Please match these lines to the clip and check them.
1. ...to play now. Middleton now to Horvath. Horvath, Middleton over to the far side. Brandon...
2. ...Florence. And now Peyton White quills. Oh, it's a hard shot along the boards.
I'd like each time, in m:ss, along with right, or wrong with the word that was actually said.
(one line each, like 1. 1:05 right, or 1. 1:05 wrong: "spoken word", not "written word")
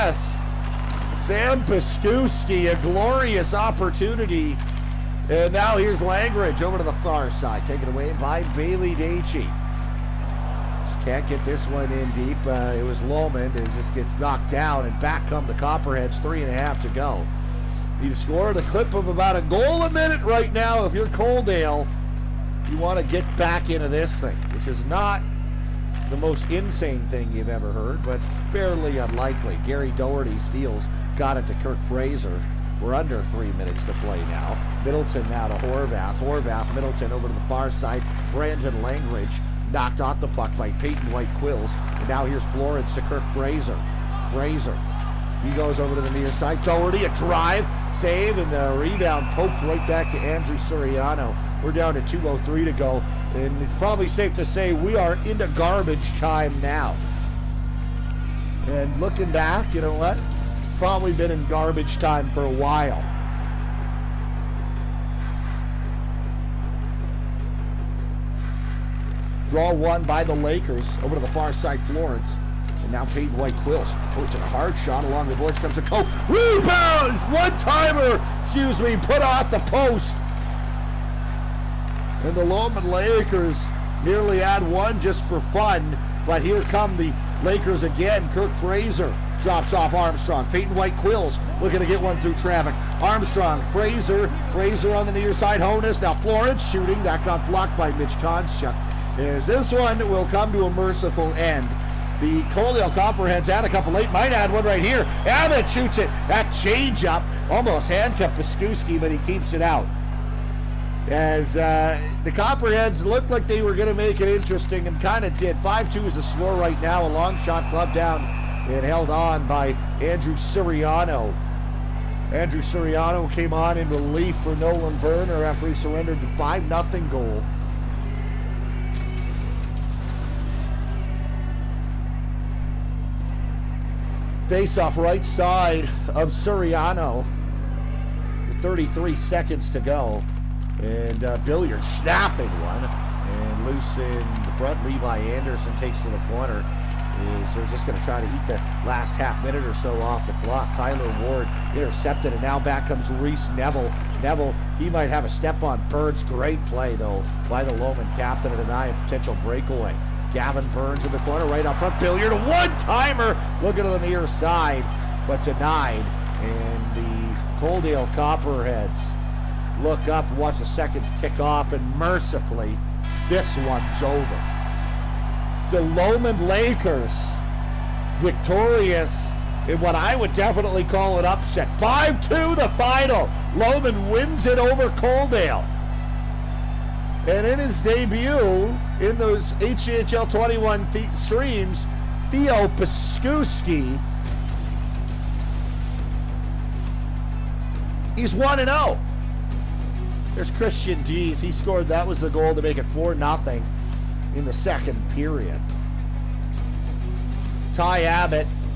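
1. 0:33 right
2. 1:11 right.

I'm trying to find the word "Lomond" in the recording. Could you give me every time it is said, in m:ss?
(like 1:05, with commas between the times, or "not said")
0:13, 1:22, 2:37, 2:55, 3:03.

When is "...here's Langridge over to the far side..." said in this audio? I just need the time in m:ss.
0:05.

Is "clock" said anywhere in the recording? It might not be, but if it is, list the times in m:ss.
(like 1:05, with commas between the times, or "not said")
2:30.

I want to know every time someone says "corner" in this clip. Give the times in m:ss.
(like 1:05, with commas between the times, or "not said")
2:26, 2:41.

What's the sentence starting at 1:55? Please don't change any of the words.
5-2 is a score right now.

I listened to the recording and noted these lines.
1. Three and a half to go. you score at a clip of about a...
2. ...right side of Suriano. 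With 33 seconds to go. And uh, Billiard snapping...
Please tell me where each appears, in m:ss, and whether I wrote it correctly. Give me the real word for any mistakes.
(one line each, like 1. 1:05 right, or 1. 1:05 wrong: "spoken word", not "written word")
1. 0:16 right
2. 2:14 right.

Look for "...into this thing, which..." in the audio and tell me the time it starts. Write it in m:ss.
0:23.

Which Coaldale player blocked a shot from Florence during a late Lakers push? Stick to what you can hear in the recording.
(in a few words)
Mitch Konchuk.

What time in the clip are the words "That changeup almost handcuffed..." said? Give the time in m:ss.
1:46.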